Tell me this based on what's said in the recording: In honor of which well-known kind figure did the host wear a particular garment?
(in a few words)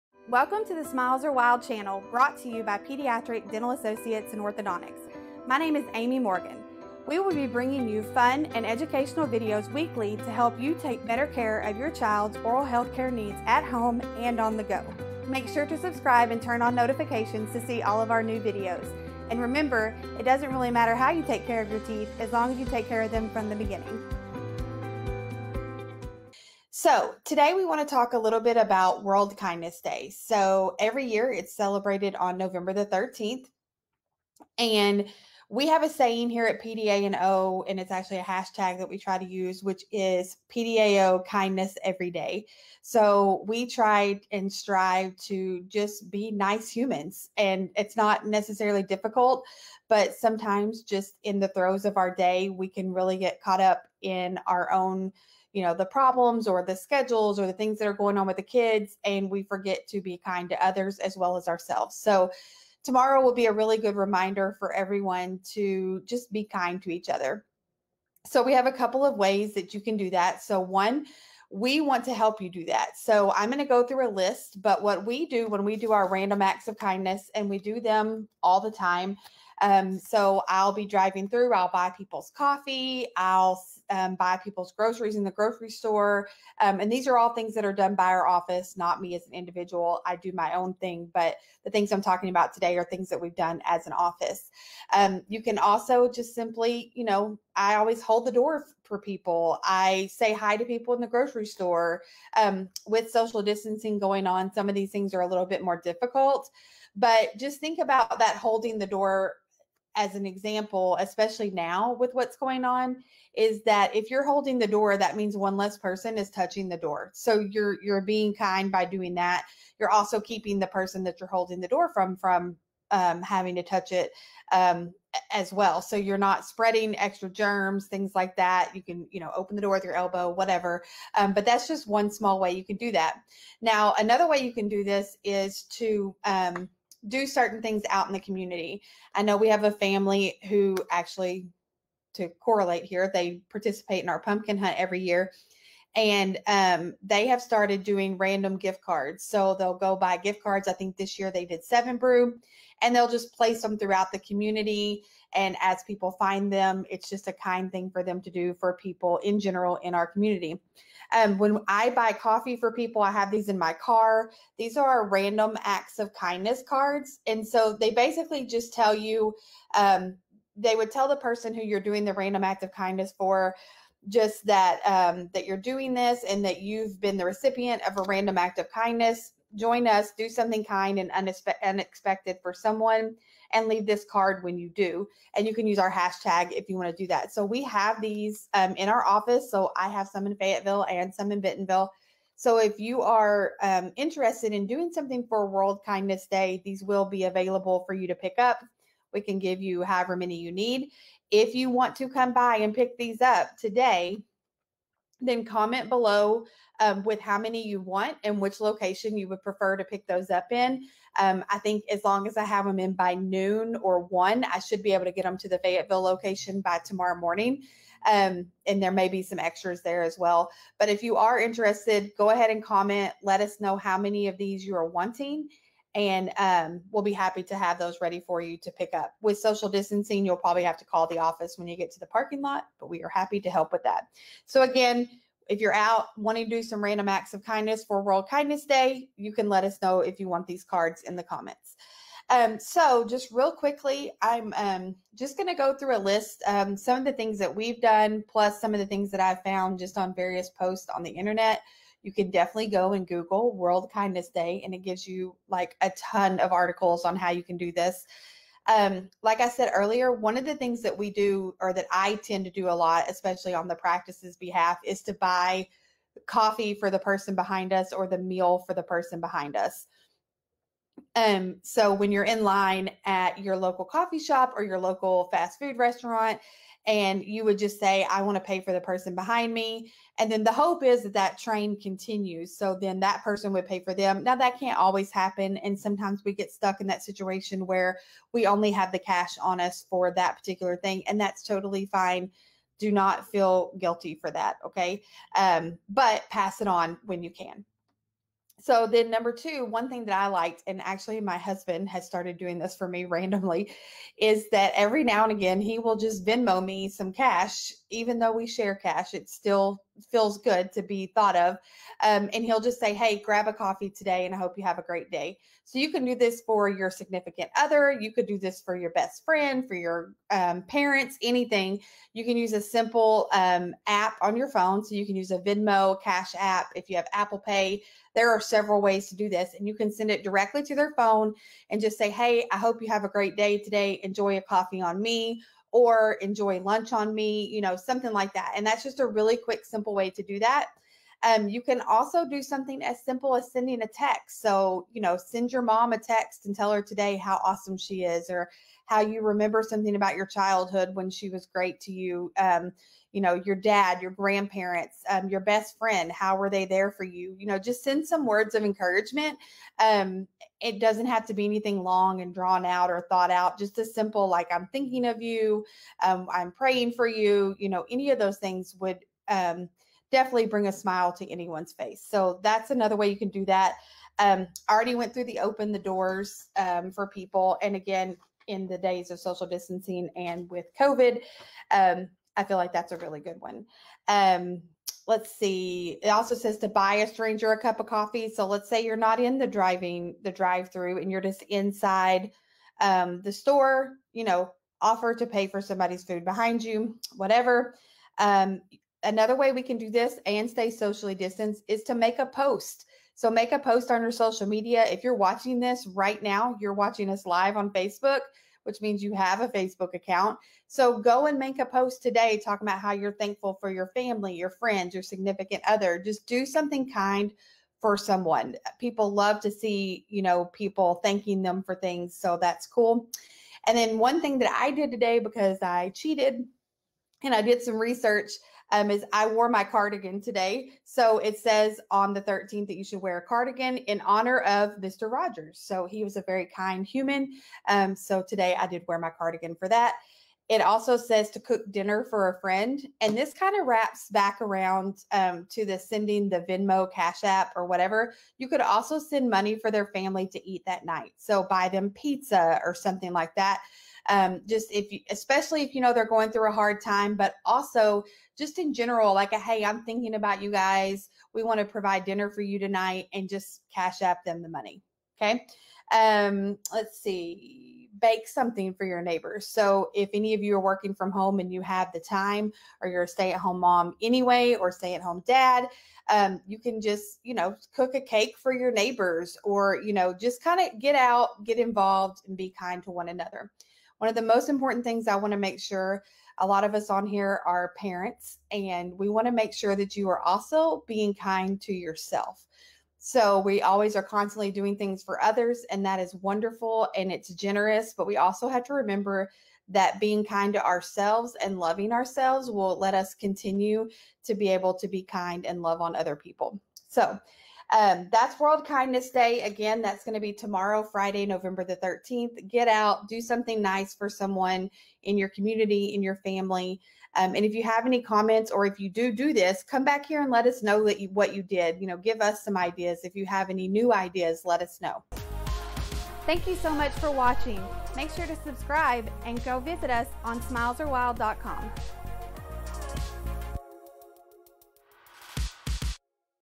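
Mr. Rogers.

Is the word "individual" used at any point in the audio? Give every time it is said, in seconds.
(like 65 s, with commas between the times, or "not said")
89 s.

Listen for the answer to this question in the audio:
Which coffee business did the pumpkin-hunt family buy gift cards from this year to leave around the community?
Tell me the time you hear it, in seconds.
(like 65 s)
151 s.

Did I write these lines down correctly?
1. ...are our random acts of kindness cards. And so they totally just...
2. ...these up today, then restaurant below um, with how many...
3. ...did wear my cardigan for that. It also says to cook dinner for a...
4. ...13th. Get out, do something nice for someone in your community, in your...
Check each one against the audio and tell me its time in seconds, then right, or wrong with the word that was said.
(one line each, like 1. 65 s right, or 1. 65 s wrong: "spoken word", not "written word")
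1. 164 s wrong: "basically", not "totally"
2. 202 s wrong: "comment", not "restaurant"
3. 438 s right
4. 511 s right.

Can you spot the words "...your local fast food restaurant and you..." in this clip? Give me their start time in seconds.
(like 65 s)
274 s.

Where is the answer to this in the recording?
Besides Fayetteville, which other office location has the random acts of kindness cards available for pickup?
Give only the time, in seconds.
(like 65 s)
191 s.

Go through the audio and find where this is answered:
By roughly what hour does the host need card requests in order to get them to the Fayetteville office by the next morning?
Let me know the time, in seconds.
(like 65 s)
213 s.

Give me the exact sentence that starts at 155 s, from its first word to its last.
And as people find them, it's just a kind thing for them to do for people in general in our community.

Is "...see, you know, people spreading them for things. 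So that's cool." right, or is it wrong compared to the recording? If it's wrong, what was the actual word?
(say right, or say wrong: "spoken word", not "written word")
wrong: "thanking", not "spreading".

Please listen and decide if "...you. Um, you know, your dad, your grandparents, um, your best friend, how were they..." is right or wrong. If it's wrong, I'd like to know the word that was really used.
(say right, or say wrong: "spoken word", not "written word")
right.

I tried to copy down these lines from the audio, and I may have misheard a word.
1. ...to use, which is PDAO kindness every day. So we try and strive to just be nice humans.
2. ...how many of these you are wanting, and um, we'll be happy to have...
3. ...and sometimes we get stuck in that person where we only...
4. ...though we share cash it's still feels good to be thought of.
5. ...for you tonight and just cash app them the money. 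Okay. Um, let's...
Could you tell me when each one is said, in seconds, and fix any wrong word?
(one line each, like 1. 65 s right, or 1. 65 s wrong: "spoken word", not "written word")
1. 39 s right
2. 223 s right
3. 285 s wrong: "situation", not "person"
4. 308 s right
5. 462 s right.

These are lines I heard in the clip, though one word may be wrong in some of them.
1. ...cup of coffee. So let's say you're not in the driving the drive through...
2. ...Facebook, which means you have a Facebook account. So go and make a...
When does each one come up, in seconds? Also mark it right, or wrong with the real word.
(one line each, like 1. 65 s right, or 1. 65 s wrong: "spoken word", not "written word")
1. 387 s right
2. 407 s right.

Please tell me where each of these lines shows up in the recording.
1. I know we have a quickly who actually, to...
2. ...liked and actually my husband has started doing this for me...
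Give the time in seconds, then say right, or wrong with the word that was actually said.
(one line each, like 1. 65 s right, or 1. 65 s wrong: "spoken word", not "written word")
1. 139 s wrong: "family", not "quickly"
2. 300 s right.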